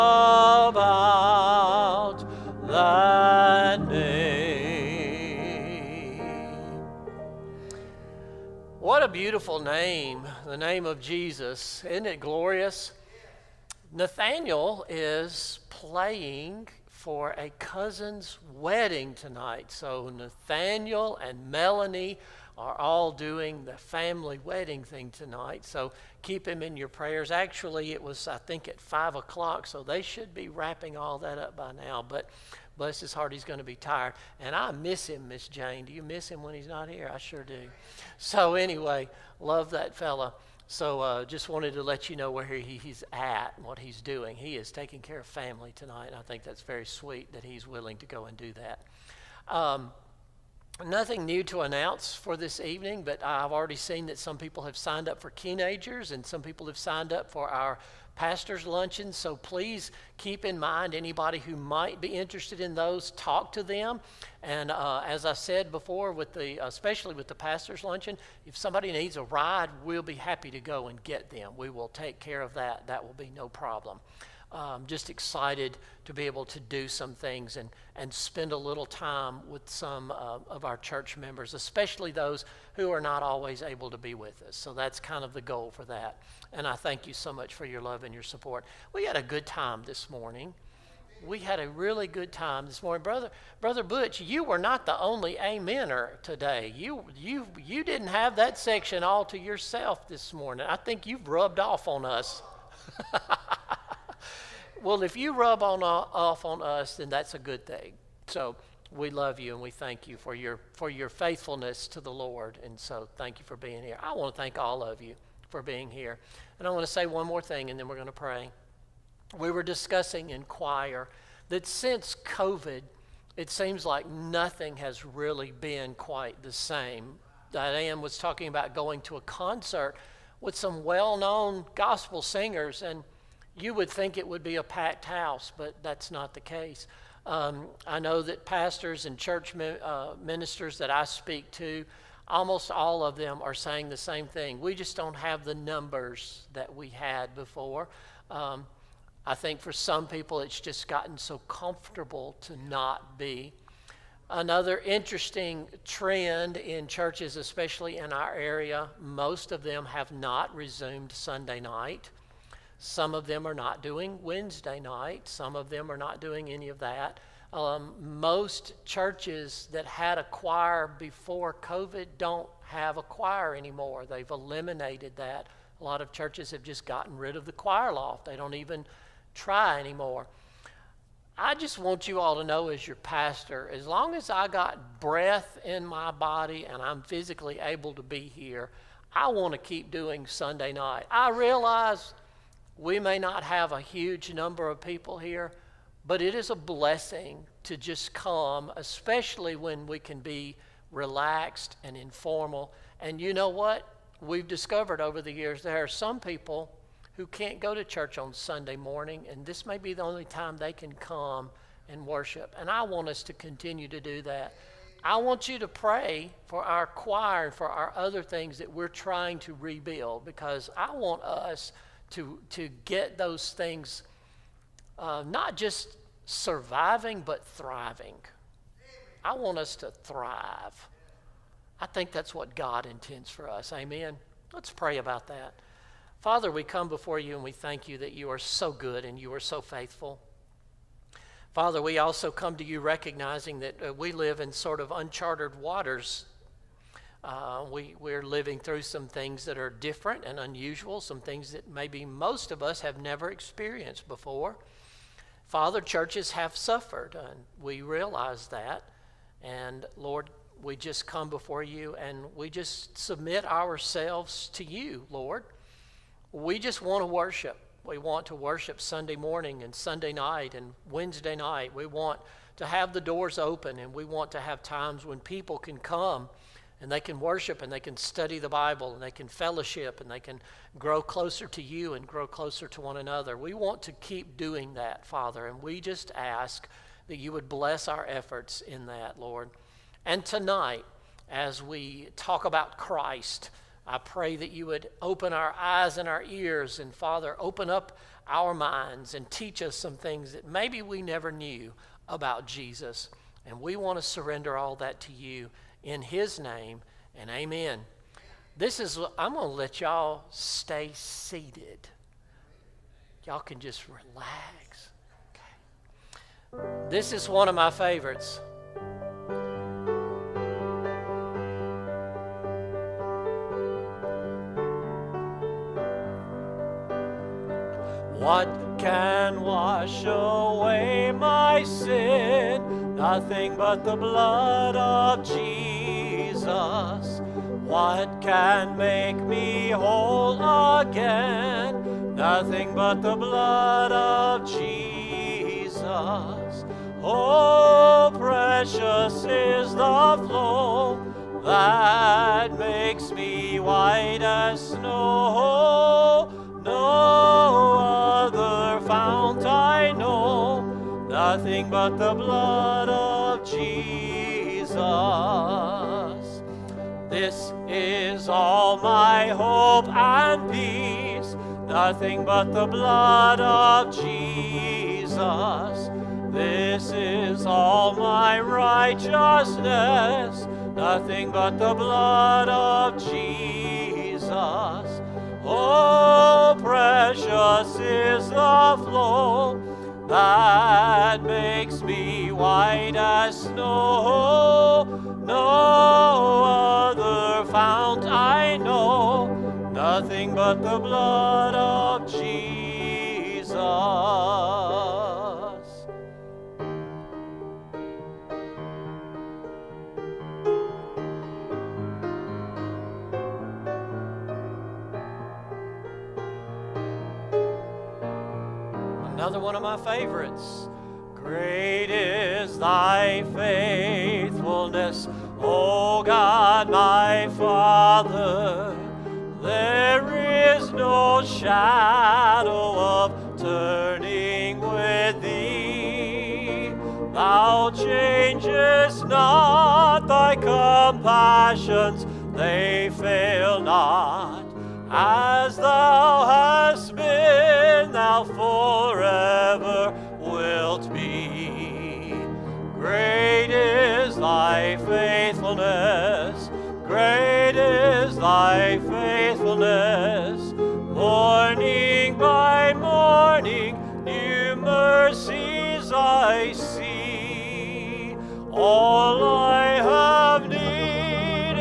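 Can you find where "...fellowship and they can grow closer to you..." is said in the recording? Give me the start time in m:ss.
4:39.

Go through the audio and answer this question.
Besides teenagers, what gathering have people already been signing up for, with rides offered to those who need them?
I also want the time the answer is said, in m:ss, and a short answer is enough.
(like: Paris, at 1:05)
pastor's luncheons, at 0:58.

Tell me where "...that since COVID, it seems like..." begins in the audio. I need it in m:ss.
2:01.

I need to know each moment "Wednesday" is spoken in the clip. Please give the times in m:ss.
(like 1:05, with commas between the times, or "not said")
2:44, 4:30.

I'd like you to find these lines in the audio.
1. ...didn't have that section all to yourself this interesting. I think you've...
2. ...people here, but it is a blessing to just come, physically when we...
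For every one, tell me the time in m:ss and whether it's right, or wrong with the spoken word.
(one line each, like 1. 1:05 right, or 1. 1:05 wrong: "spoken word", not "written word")
1. 1:37 wrong: "morning", not "interesting"
2. 3:14 wrong: "especially", not "physically".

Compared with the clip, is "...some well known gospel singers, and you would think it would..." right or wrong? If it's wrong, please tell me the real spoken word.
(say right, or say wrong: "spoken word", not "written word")
right.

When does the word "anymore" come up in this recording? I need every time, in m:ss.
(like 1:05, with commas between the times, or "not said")
2:53, 2:59.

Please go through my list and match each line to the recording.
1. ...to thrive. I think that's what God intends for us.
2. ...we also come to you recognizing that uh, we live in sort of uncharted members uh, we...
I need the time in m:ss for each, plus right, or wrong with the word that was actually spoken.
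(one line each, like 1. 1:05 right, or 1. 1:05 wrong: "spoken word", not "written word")
1. 3:49 right
2. 4:01 wrong: "waters", not "members".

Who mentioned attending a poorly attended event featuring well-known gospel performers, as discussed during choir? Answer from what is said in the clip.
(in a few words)
Diane.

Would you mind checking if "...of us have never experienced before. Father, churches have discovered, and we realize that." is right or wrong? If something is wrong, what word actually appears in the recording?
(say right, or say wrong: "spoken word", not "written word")
wrong: "suffered", not "discovered".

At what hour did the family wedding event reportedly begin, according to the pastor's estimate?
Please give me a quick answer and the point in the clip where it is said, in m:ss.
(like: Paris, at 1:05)
5 o'clock, at 0:28.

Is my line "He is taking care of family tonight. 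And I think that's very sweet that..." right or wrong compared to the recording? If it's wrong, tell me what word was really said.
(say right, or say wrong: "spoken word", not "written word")
right.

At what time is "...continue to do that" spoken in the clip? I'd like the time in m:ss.
3:33.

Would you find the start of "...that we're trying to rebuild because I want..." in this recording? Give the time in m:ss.
3:38.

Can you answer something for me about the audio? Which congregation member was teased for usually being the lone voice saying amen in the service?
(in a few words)
Brother Butch.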